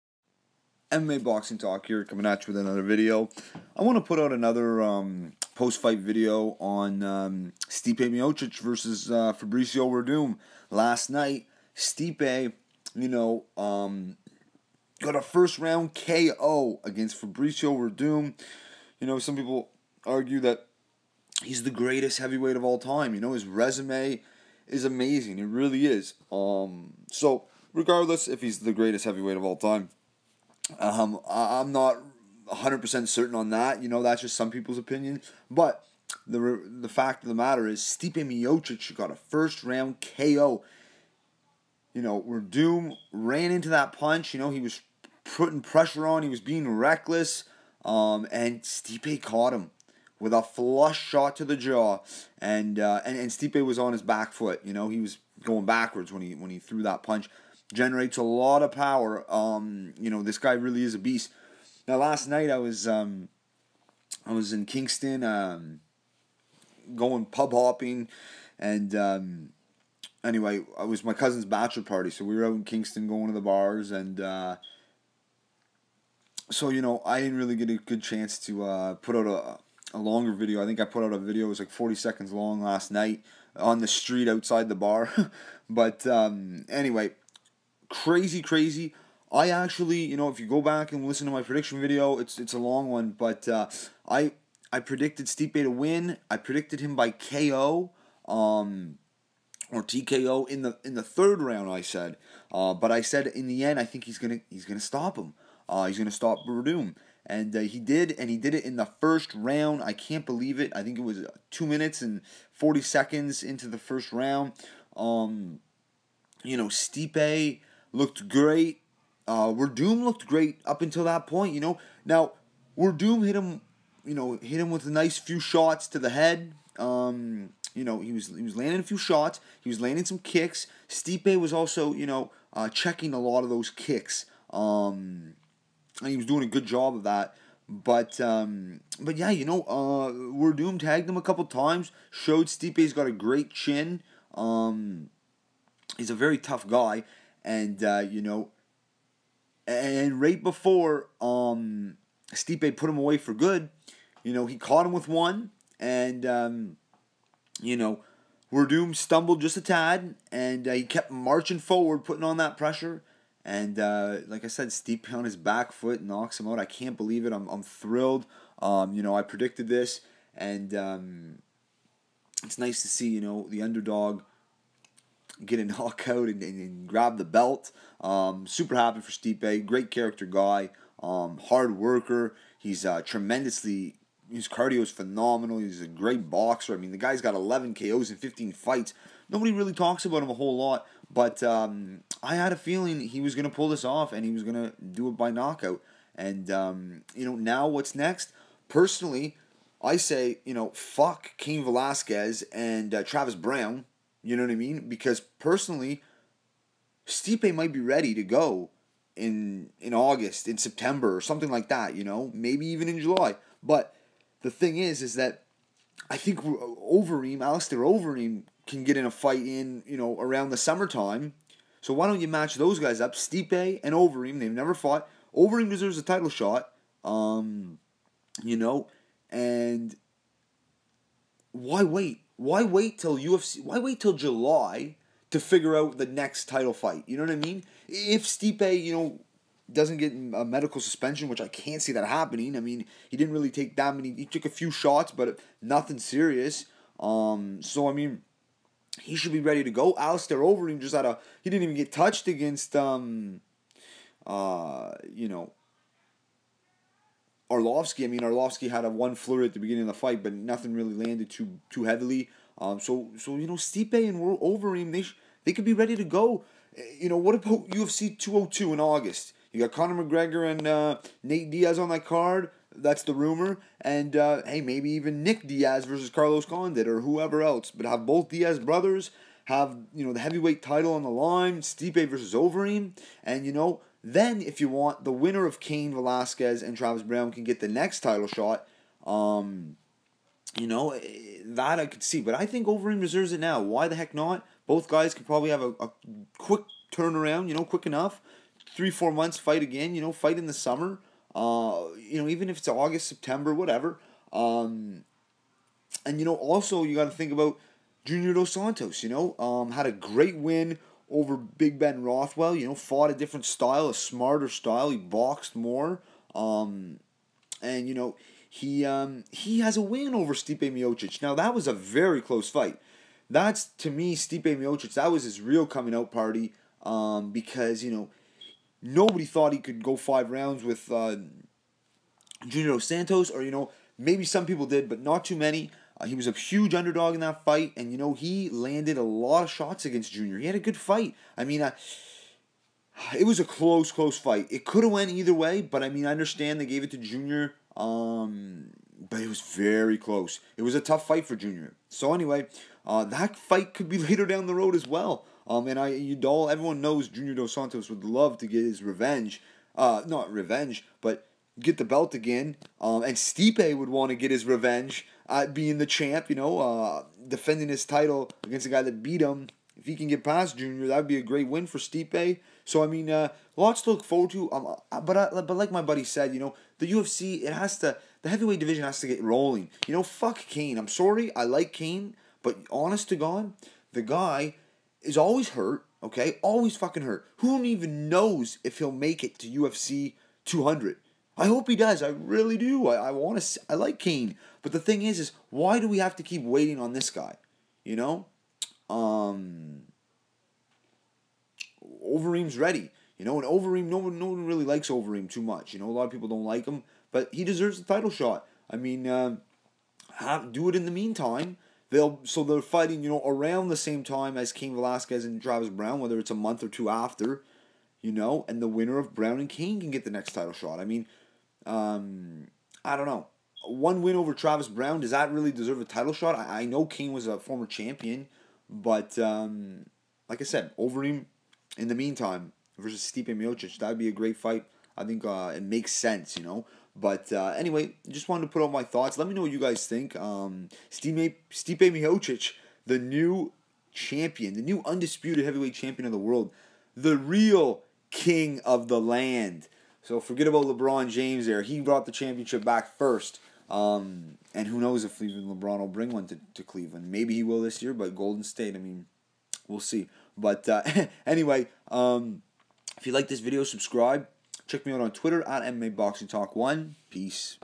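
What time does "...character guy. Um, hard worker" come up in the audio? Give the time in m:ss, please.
2:59.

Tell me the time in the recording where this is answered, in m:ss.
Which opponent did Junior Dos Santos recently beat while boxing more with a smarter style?
5:11.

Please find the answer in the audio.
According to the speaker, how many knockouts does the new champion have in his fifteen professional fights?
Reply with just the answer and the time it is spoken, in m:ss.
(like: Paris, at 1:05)
11, at 3:07.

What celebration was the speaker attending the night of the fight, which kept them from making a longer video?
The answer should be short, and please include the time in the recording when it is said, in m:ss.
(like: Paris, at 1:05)
Cousin's bachelor party, at 1:11.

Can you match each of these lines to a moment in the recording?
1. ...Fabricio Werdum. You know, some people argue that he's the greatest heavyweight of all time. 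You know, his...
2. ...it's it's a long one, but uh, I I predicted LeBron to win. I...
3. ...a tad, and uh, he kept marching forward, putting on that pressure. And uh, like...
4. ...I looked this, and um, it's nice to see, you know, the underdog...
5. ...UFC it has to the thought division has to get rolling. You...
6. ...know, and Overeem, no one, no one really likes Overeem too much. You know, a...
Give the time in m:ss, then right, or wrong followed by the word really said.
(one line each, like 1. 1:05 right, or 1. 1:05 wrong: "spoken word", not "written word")
1. 0:17 right
2. 1:32 wrong: "Stipe", not "LeBron"
3. 2:39 right
4. 2:49 wrong: "predicted", not "looked"
5. 6:16 wrong: "heavyweight", not "thought"
6. 6:43 right.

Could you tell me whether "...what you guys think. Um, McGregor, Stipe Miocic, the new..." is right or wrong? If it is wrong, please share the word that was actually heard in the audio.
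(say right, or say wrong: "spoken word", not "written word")
wrong: "Stipe", not "McGregor".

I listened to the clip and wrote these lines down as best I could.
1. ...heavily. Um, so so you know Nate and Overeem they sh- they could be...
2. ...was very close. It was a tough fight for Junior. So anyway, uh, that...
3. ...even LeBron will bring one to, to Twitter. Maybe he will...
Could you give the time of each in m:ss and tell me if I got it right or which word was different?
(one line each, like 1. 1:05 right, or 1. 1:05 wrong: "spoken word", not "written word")
1. 4:21 wrong: "Stipe", not "Nate"
2. 5:49 right
3. 7:35 wrong: "Cleveland", not "Twitter".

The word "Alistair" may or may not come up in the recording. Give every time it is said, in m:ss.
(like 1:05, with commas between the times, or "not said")
3:37, 4:09.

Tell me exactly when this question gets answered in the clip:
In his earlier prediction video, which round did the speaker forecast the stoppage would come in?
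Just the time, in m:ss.
1:41.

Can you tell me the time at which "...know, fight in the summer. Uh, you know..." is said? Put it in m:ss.
5:00.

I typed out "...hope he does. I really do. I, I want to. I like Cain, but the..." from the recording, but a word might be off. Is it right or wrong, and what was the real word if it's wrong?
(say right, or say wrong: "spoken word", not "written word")
right.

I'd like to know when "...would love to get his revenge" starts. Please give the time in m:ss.
5:57.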